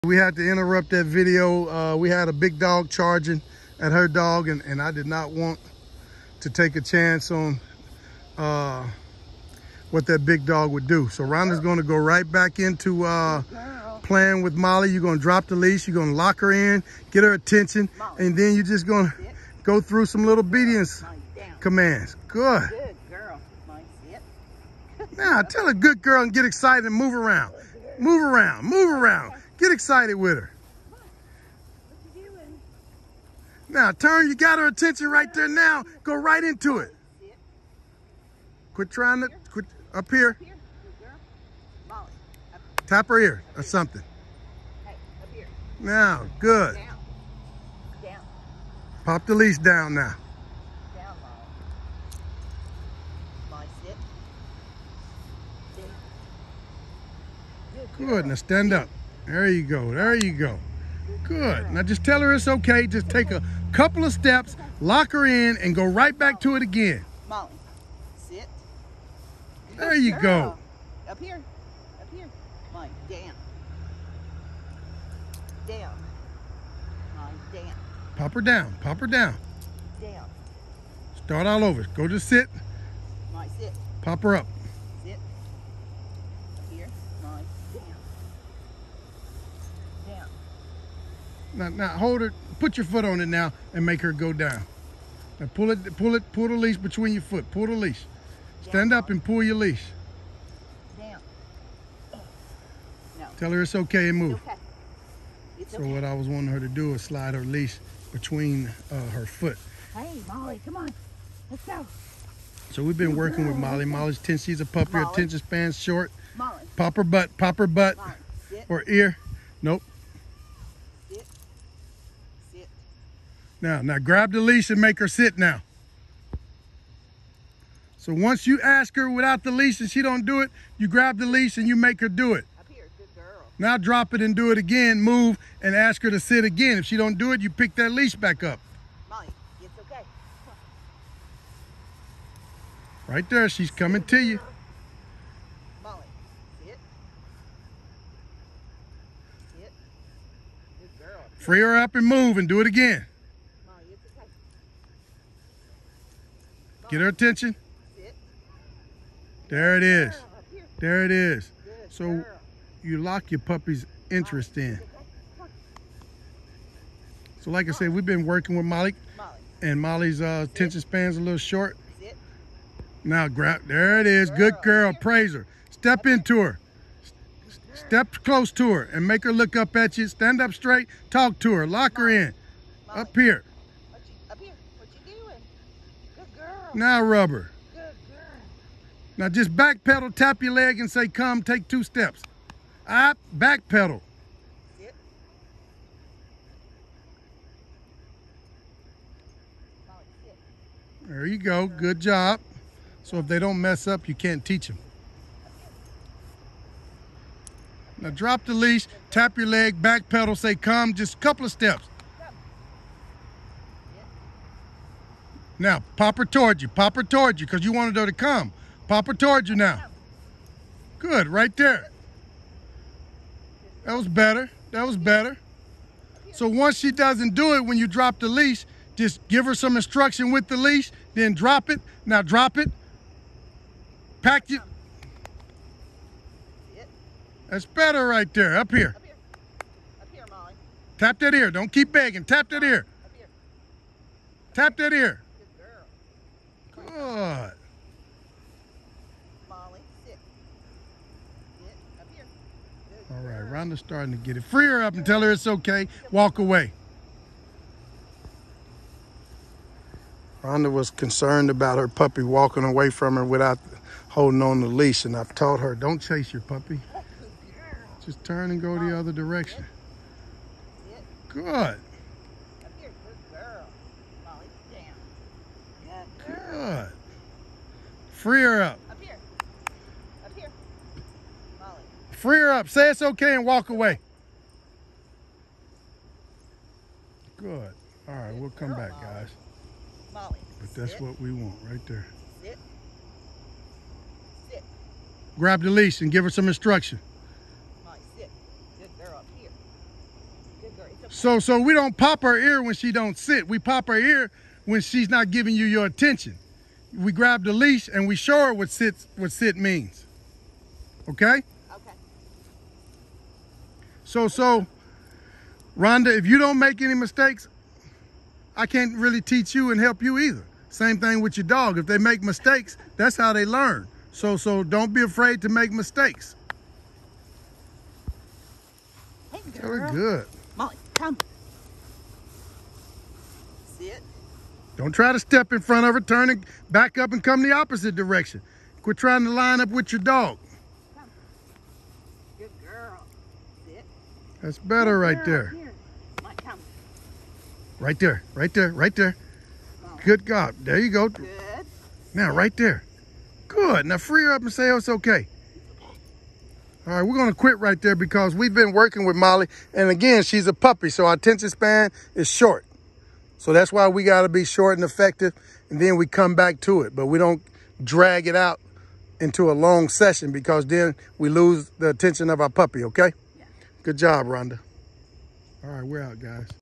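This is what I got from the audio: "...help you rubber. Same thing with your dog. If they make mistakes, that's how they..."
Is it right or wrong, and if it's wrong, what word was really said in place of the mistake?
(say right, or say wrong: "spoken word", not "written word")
wrong: "either", not "rubber".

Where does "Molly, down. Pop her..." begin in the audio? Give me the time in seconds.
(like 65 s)
77 s.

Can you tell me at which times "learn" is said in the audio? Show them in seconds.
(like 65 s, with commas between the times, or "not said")
323 s.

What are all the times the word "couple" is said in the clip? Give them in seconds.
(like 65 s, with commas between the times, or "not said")
63 s, 211 s.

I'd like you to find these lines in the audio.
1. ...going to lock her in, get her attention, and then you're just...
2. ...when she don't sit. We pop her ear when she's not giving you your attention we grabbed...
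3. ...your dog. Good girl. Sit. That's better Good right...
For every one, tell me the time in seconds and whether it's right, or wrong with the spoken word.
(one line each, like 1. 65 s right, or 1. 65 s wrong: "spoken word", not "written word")
1. 15 s right
2. 302 s right
3. 339 s right.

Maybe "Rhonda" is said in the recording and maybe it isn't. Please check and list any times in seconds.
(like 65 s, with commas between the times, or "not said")
11 s, 253 s, 260 s, 315 s, 374 s.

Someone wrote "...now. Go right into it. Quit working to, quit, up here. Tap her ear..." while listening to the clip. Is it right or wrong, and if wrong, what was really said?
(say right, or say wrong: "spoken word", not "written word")
wrong: "trying", not "working".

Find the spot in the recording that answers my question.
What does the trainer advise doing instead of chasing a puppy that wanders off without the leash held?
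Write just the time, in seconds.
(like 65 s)
268 s.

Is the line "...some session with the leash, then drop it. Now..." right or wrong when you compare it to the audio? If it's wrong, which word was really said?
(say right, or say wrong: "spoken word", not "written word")
wrong: "instruction", not "session".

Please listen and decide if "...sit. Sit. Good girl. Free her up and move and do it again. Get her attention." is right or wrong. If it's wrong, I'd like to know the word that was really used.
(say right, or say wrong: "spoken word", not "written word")
right.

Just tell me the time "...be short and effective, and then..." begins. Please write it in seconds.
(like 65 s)
364 s.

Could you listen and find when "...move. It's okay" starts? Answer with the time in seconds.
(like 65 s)
104 s.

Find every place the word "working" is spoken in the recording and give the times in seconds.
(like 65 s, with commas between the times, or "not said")
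113 s, 168 s, 358 s.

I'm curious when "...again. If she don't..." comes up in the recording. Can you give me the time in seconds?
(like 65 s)
136 s.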